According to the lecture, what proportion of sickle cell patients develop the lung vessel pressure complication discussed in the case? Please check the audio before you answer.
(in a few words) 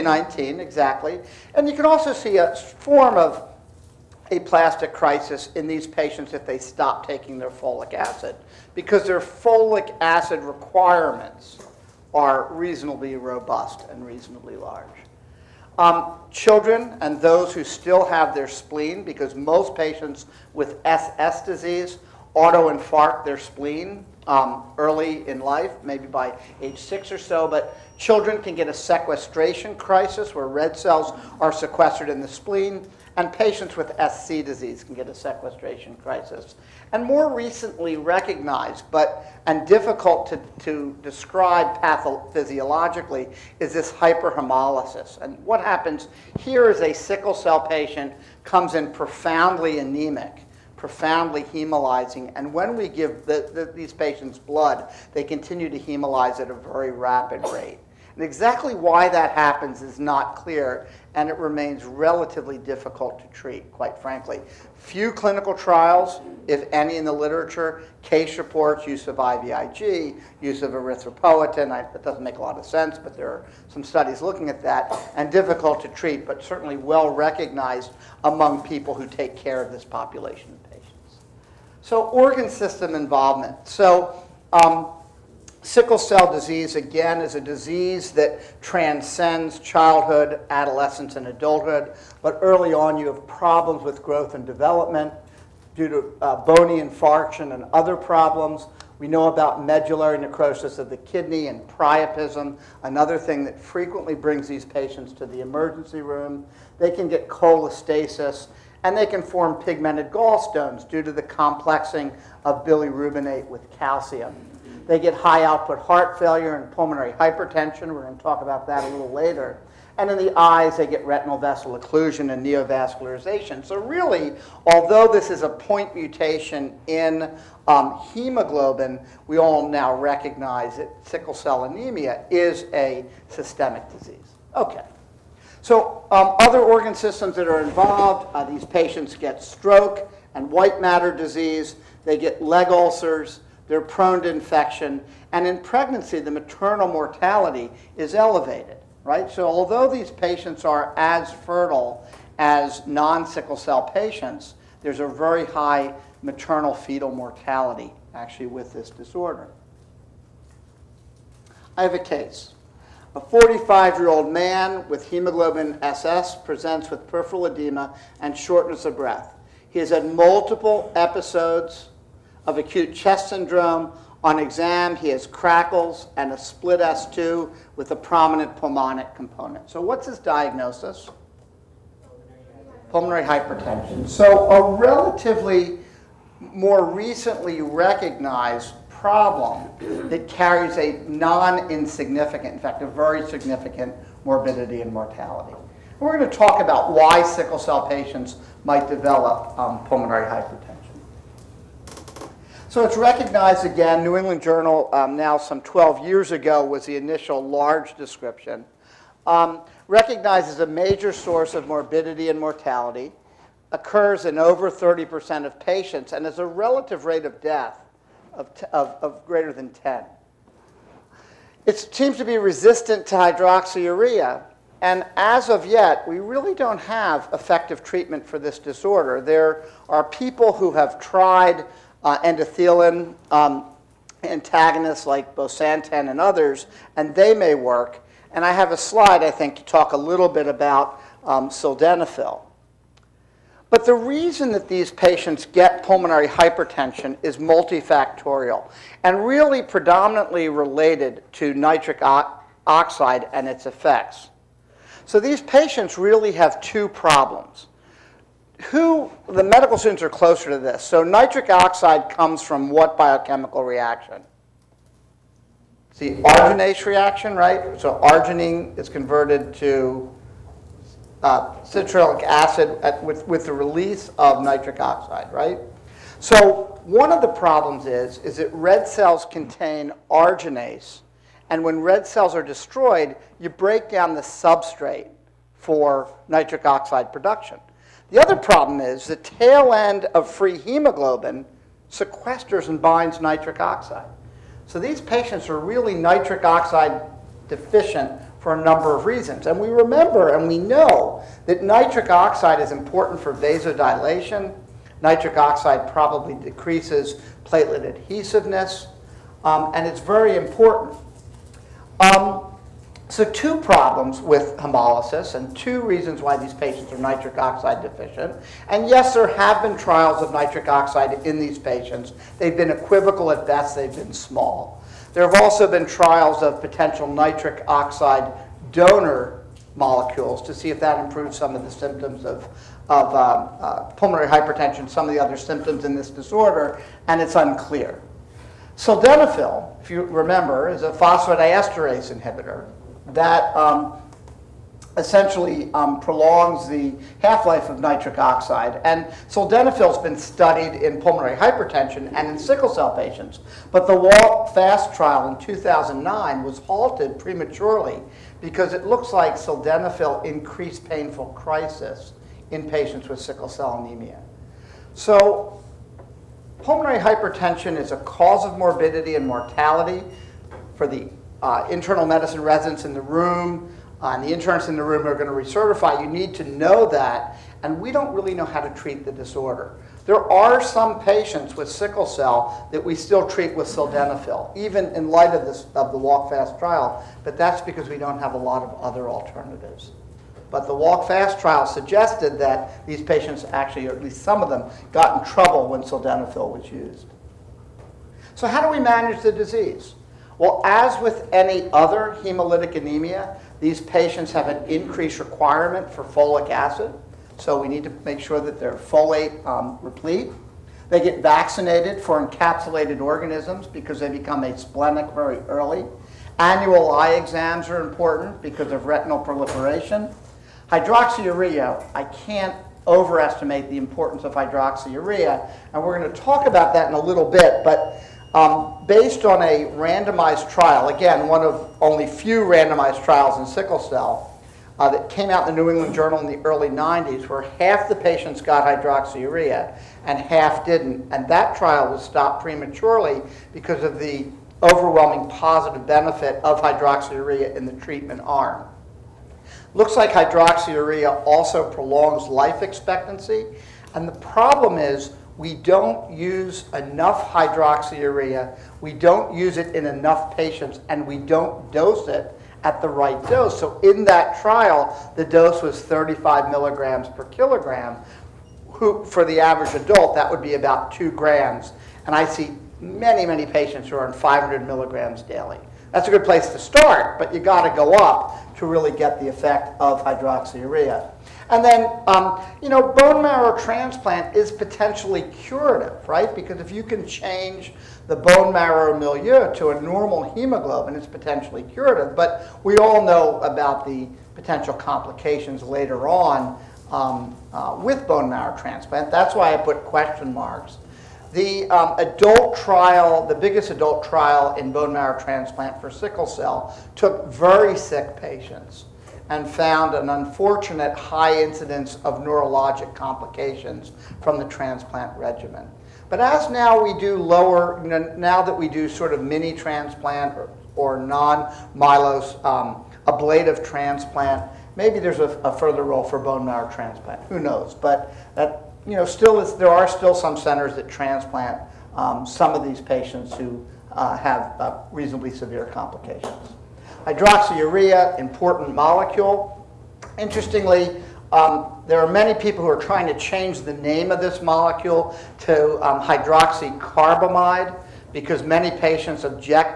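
over 30%.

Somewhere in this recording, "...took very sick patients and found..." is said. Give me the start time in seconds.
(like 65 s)
506 s.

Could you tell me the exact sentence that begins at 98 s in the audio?
We know about medullary necrosis of the kidney and priapism, another thing that frequently brings these patients to the emergency room.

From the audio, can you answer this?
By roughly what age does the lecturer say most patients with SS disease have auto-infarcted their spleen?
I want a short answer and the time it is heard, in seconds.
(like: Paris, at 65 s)
6, at 26 s.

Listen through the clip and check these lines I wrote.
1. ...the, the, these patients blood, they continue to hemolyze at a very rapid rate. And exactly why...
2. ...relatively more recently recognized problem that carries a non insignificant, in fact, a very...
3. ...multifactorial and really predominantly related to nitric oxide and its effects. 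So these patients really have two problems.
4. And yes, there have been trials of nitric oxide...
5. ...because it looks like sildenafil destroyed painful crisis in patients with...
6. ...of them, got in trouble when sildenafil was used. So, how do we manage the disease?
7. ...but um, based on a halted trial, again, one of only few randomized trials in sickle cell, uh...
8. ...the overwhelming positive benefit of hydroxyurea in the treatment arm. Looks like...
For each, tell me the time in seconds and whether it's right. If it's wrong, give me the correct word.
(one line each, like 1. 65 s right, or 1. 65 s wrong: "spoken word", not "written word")
1. 53 s right
2. 184 s right
3. 247 s right
4. 318 s right
5. 358 s wrong: "increased", not "destroyed"
6. 394 s right
7. 427 s wrong: "randomized", not "halted"
8. 443 s right.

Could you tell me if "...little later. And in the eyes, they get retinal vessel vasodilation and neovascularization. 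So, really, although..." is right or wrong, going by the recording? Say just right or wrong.
wrong.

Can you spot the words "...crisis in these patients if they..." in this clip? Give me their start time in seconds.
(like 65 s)
4 s.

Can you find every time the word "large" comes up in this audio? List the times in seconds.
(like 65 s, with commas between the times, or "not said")
14 s, 207 s.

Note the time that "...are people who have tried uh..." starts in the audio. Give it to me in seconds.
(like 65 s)
229 s.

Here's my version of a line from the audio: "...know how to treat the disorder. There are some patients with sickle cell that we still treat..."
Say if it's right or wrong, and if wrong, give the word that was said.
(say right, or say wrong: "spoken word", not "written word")
right.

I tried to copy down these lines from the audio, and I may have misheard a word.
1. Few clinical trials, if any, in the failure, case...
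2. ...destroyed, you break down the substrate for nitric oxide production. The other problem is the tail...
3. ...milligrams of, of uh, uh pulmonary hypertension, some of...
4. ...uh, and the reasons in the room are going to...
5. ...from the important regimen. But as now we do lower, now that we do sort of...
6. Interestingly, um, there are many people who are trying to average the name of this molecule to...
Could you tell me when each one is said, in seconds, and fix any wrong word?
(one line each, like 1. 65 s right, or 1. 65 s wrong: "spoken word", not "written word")
1. 64 s wrong: "literature", not "failure"
2. 282 s right
3. 331 s wrong: "symptoms", not "milligrams"
4. 374 s wrong: "interns", not "reasons"
5. 514 s wrong: "transplant", not "important"
6. 540 s wrong: "change", not "average".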